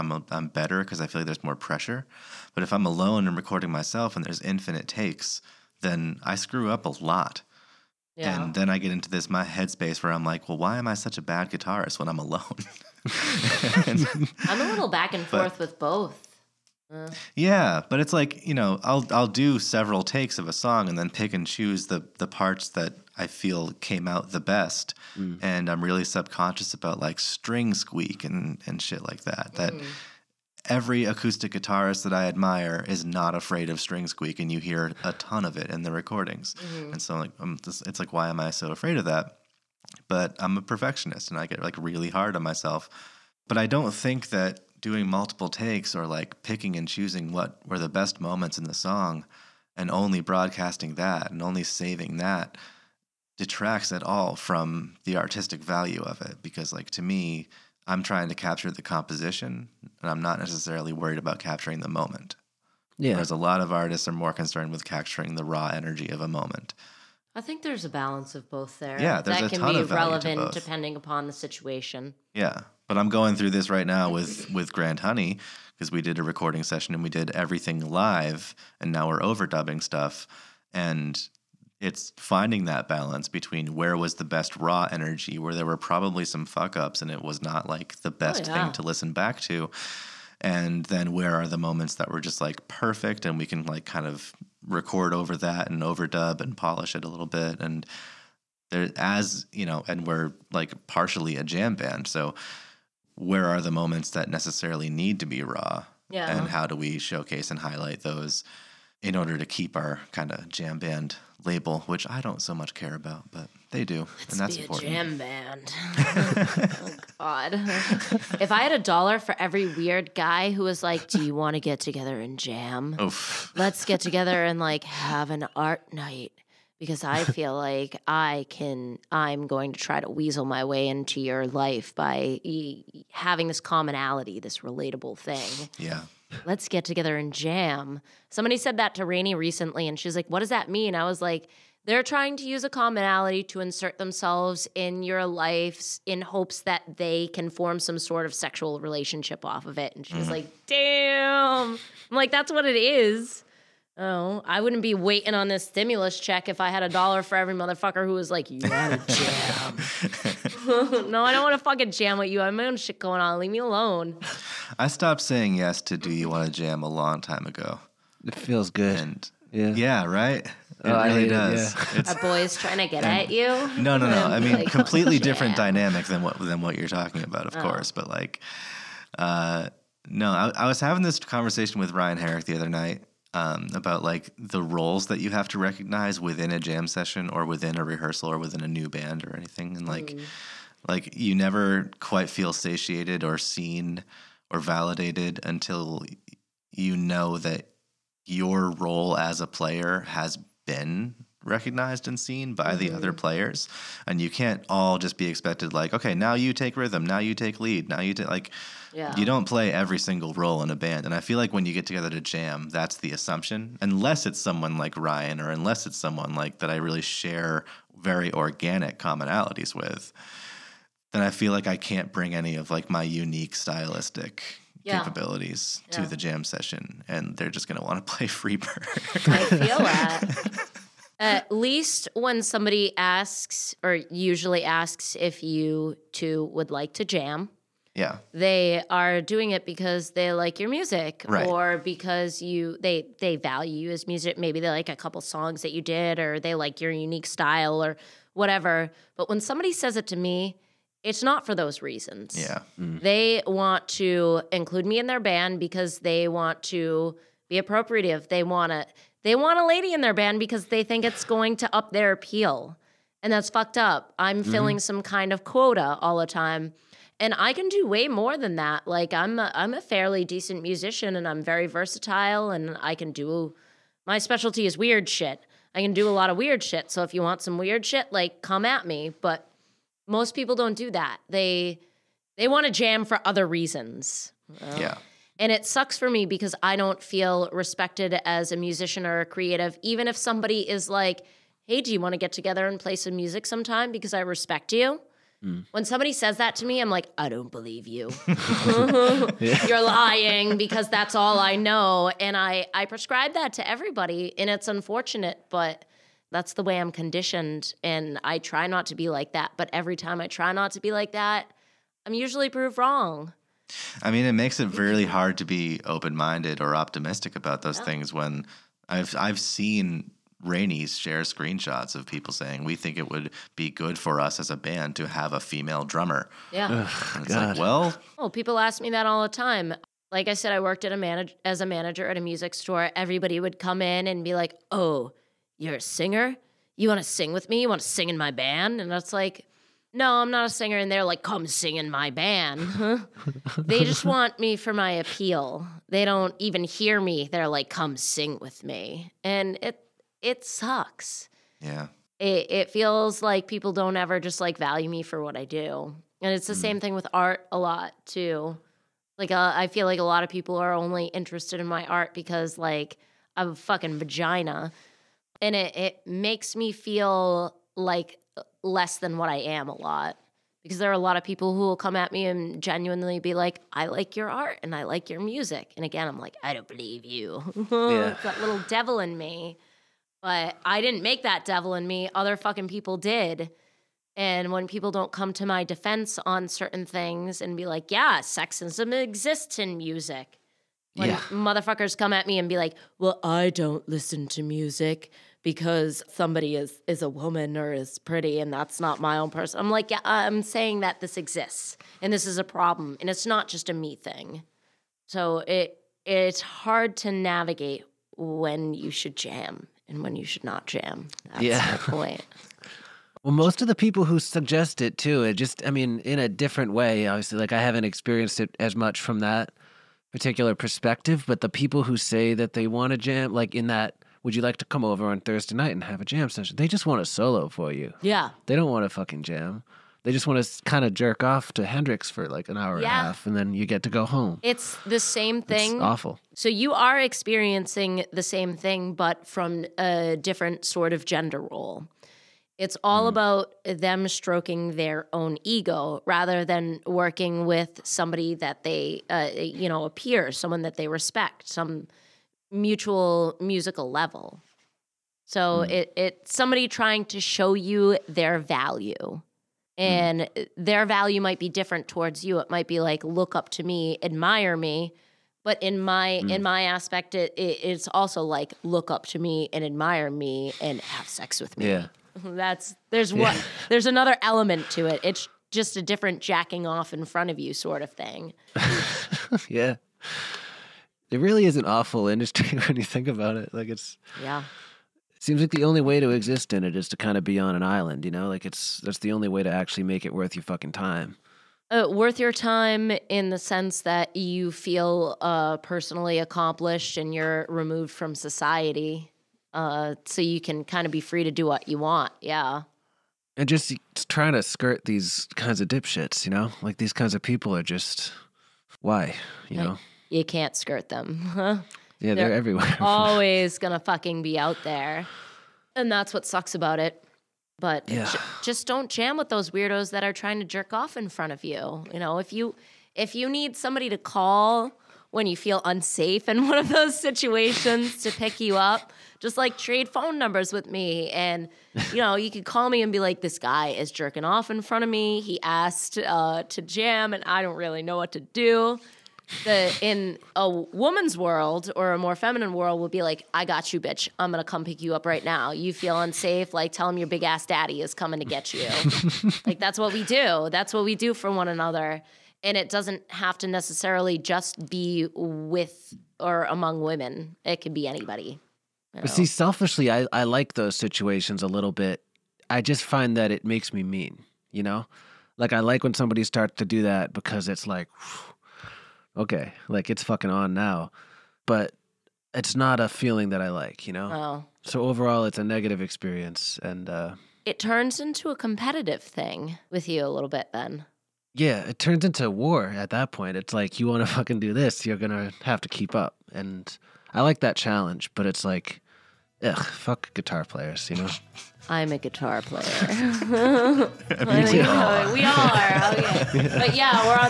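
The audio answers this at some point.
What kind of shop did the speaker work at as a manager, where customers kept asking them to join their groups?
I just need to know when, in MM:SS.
05:32.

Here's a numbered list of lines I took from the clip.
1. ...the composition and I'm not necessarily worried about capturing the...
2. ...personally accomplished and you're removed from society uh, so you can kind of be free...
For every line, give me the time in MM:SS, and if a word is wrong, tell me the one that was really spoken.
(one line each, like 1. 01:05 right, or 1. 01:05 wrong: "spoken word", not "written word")
1. 00:58 right
2. 08:15 right.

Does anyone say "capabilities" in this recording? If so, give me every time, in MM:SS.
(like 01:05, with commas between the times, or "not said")
03:44.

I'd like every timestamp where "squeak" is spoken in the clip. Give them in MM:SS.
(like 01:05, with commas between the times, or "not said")
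00:27, 00:34.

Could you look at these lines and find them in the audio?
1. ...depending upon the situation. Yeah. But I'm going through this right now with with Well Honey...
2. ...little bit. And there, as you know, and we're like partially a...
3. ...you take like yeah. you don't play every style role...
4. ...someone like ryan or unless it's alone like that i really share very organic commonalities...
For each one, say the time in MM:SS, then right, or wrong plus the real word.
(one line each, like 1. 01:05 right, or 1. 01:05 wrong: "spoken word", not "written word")
1. 01:10 wrong: "Grand", not "Well"
2. 01:37 right
3. 03:27 wrong: "single", not "style"
4. 03:34 wrong: "someone", not "alone".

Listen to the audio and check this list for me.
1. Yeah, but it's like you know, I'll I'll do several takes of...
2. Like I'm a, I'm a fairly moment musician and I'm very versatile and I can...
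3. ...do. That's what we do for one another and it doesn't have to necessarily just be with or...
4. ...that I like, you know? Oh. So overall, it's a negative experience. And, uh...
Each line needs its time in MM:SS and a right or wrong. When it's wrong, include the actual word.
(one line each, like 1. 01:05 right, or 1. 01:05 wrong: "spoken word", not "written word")
1. 00:17 right
2. 04:28 wrong: "decent", not "moment"
3. 09:10 right
4. 09:33 right.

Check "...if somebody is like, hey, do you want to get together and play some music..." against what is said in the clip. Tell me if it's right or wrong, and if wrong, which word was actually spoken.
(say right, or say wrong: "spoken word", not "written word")
right.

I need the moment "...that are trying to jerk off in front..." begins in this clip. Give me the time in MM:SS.
08:39.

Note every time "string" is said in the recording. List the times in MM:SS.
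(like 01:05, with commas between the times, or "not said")
00:27, 00:33.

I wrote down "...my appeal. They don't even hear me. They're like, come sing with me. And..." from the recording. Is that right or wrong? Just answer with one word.
right.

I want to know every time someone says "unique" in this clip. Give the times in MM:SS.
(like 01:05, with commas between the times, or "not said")
03:43, 04:06.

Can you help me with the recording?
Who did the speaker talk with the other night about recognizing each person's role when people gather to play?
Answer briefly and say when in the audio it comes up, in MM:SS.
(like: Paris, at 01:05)
Ryan Herrick, at 03:01.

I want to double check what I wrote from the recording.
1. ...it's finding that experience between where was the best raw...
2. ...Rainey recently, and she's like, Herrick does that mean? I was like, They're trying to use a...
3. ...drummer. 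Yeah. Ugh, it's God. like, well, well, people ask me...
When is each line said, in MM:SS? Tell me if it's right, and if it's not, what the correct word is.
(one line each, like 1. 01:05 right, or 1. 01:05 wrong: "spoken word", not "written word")
1. 01:21 wrong: "balance", not "experience"
2. 02:19 wrong: "What", not "Herrick"
3. 05:25 right.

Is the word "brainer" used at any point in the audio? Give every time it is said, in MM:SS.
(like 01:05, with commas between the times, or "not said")
not said.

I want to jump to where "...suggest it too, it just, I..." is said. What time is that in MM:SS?
06:54.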